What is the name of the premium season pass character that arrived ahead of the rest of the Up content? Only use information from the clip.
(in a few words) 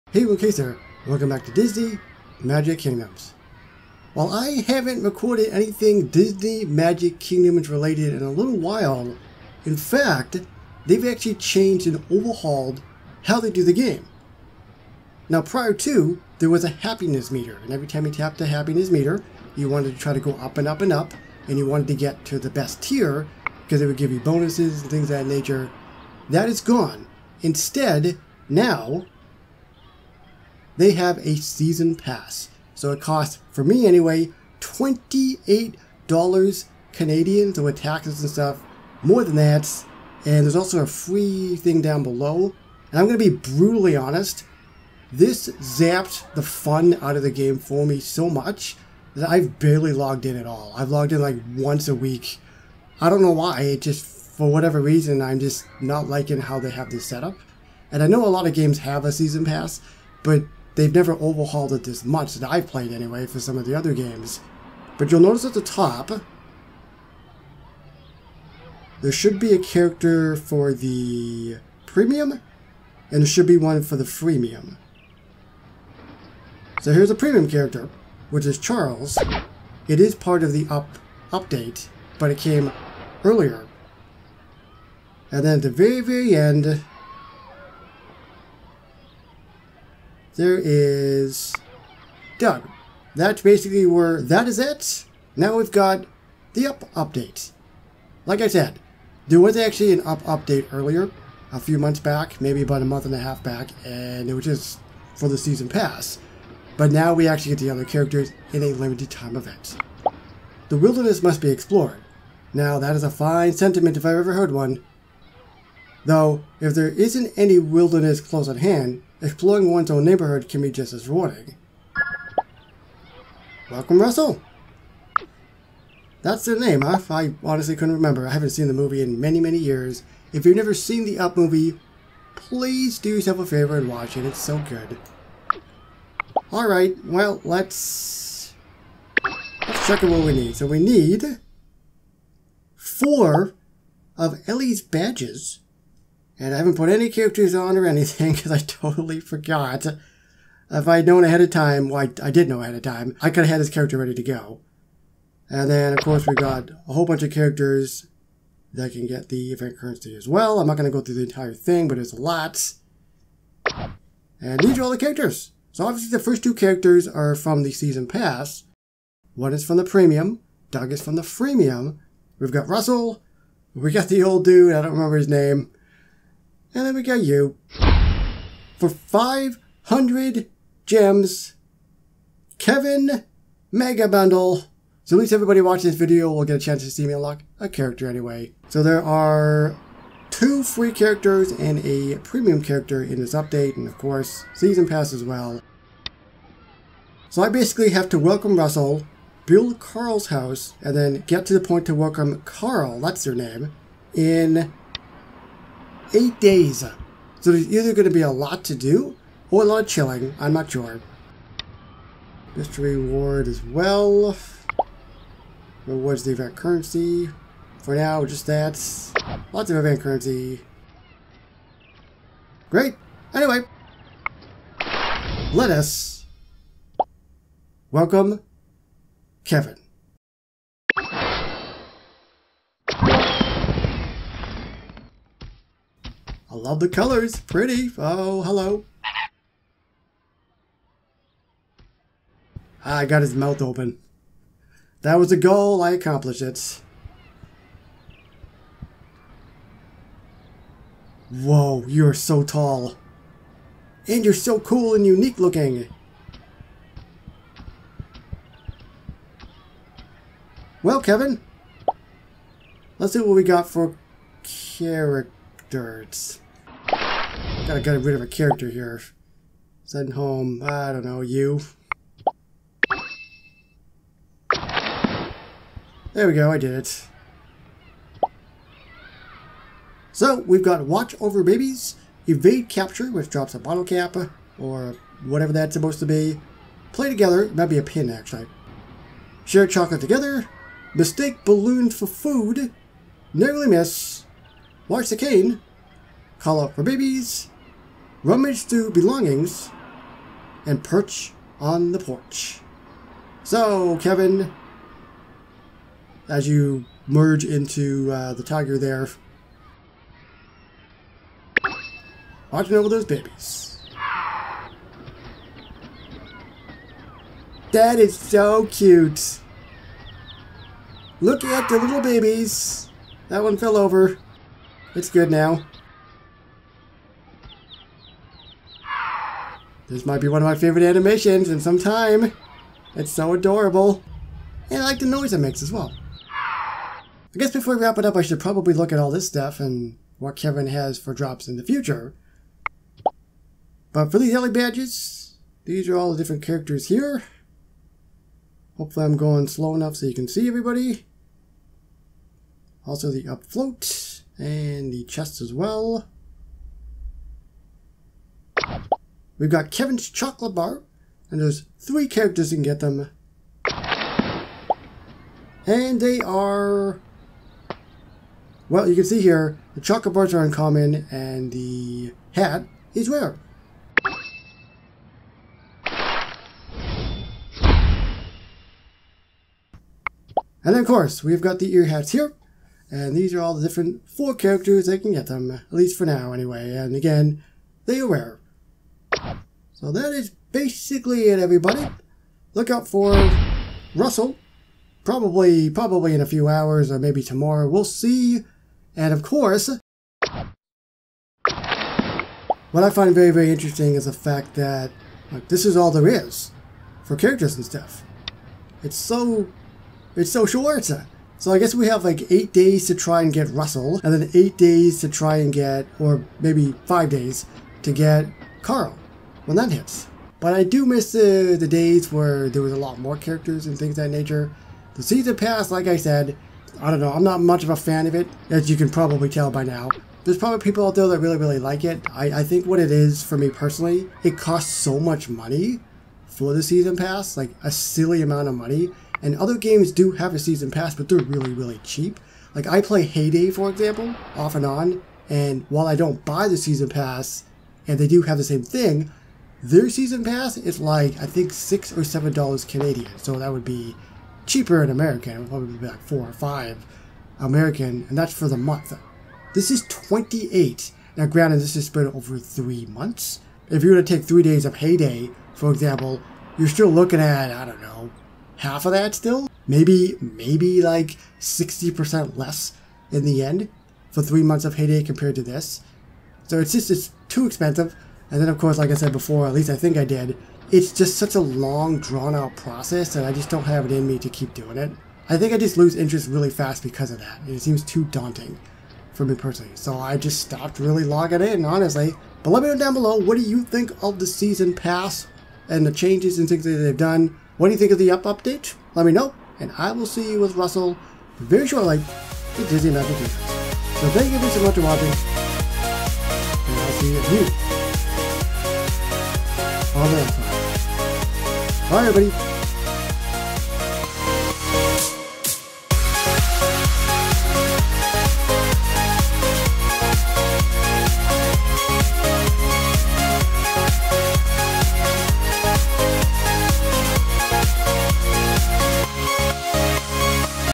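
Charles.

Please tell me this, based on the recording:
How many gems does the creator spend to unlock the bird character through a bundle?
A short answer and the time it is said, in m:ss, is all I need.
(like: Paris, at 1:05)
500, at 2:58.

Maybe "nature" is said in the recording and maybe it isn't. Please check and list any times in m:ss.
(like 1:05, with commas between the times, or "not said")
0:25, 7:04.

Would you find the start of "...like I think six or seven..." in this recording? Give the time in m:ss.
7:30.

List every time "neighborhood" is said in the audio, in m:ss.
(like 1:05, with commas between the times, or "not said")
2:00.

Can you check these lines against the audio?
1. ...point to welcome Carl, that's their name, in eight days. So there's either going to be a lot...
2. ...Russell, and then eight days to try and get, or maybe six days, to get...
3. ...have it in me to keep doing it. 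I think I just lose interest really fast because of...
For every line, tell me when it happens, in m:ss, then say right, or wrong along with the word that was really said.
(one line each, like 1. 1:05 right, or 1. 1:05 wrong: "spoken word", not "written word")
1. 3:21 right
2. 6:53 wrong: "five", not "six"
3. 8:03 right.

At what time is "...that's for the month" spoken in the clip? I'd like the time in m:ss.
7:38.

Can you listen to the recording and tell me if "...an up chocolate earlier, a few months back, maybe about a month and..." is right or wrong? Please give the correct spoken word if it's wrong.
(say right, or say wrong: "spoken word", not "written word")
wrong: "update", not "chocolate".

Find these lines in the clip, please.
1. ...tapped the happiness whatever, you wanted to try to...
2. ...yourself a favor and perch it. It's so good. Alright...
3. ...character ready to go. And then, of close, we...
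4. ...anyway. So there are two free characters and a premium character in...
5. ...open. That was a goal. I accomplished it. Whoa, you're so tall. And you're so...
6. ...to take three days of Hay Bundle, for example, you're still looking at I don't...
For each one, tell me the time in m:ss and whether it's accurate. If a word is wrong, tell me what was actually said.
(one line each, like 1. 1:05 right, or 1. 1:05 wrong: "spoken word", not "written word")
1. 0:18 wrong: "meter", not "whatever"
2. 2:13 wrong: "watch", not "perch"
3. 2:33 wrong: "course", not "close"
4. 3:08 right
5. 4:03 right
6. 7:43 wrong: "Day", not "Bundle".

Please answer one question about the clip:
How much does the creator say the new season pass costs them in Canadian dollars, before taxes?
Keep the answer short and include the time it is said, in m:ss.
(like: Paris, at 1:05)
$28, at 0:34.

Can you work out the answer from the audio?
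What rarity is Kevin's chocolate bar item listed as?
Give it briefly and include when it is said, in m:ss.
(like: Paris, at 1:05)
Uncommon, at 6:10.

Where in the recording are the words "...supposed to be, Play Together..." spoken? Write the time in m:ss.
4:45.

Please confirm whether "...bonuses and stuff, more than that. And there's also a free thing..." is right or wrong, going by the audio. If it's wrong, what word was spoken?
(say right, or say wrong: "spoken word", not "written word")
wrong: "taxes", not "bonuses".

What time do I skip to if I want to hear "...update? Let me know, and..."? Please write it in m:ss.
8:18.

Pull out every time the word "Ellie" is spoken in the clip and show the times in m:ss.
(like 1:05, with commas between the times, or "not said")
2:24, 5:44.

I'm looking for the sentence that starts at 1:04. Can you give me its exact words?
But you'll notice at the top, there should be a character for the premium, and there should be one for the freemium.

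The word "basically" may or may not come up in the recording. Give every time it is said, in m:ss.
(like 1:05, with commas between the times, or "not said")
1:33, 3:17, 6:30.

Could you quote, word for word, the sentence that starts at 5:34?
And I like the noise it makes as well.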